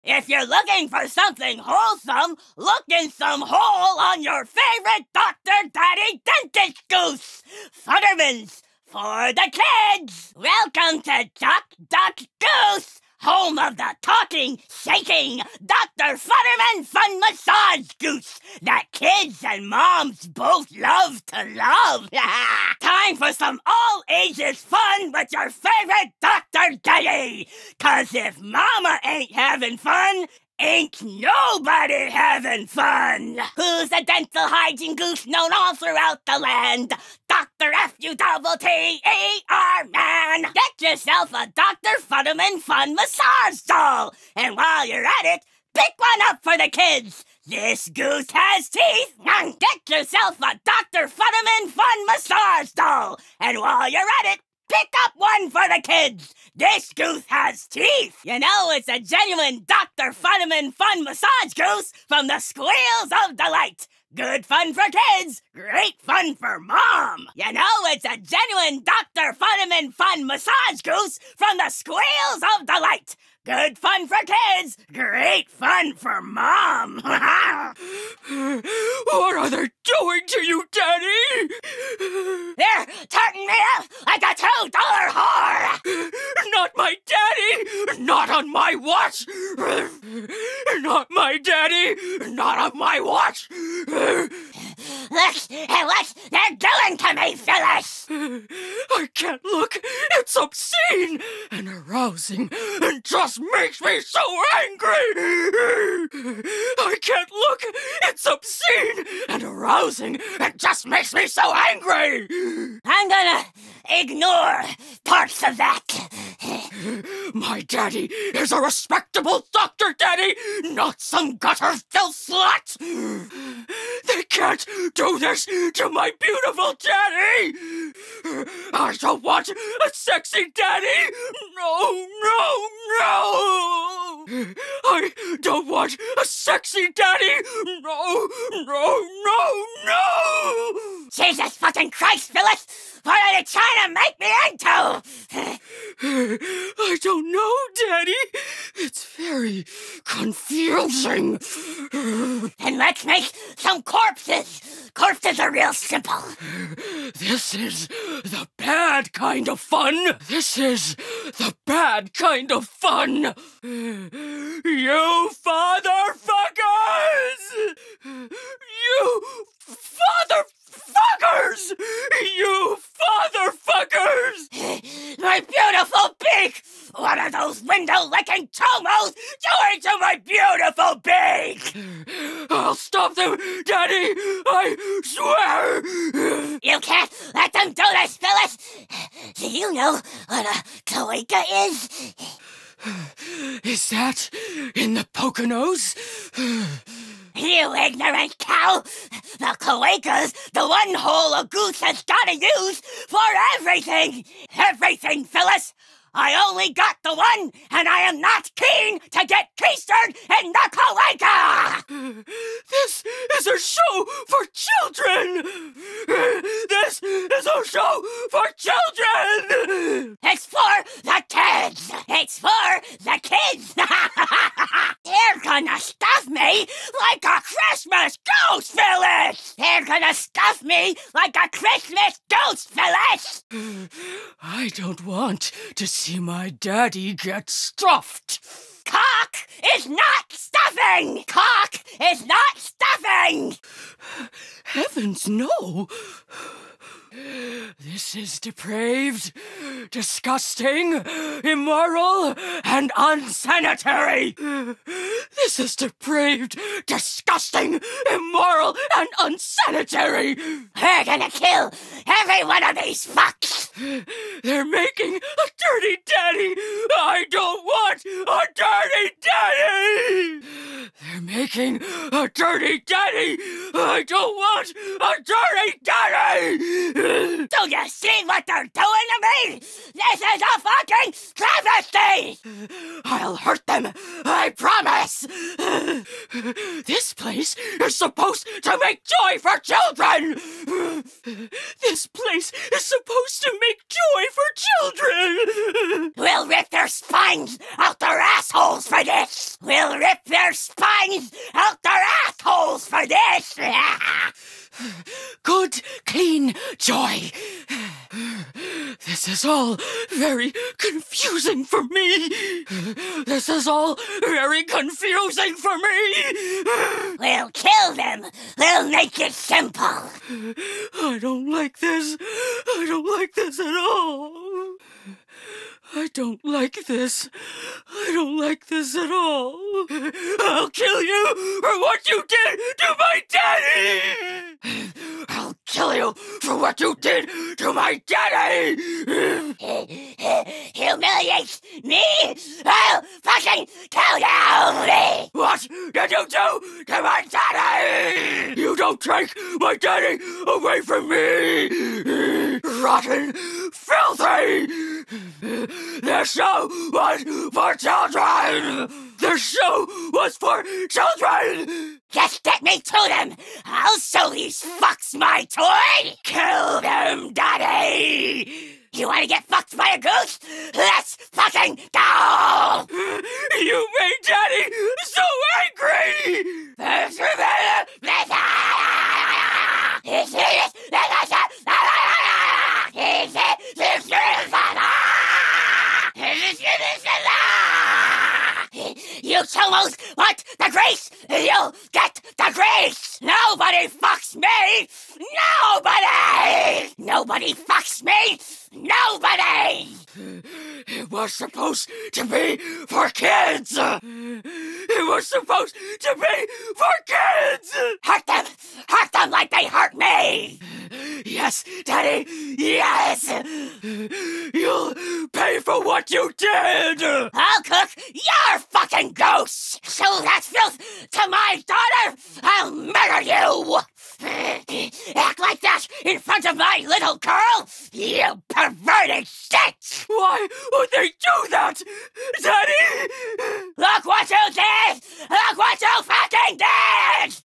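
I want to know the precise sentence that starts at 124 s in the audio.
They can't do this to my beautiful daddy!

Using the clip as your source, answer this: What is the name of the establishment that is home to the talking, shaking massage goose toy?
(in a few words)
Duck Duck Goose.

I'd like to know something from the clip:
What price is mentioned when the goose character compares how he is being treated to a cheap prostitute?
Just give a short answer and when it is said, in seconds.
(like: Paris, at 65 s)
$2, at 84 s.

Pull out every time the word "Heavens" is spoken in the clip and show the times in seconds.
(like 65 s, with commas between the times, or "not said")
244 s.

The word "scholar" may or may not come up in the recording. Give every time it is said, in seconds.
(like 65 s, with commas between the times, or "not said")
not said.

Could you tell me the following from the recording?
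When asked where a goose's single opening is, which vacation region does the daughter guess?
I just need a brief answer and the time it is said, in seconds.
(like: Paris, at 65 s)
Poconos, at 195 s.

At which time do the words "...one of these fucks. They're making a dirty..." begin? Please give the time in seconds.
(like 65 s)
262 s.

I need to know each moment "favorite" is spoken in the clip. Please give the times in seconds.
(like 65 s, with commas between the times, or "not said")
4 s, 25 s.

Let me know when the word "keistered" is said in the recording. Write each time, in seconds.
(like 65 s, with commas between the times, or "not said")
209 s.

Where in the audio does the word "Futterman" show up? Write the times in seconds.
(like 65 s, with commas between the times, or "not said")
7 s, 16 s, 42 s, 51 s, 60 s, 69 s.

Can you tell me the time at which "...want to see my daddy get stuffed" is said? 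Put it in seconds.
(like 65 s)
235 s.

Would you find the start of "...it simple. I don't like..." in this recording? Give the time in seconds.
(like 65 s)
319 s.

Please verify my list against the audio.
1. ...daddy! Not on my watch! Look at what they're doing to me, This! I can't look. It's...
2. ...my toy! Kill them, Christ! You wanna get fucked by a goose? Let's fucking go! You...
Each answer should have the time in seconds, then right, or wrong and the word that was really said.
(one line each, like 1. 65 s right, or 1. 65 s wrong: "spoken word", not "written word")
1. 91 s wrong: "Phyllis", not "This"
2. 365 s wrong: "Daddy", not "Christ".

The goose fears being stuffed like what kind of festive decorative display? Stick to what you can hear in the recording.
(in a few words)
Christmas ghost village.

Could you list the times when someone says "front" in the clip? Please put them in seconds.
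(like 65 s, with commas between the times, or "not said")
426 s.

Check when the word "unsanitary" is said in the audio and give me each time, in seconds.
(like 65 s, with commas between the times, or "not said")
252 s, 259 s.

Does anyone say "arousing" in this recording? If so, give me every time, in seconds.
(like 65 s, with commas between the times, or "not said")
101 s, 109 s.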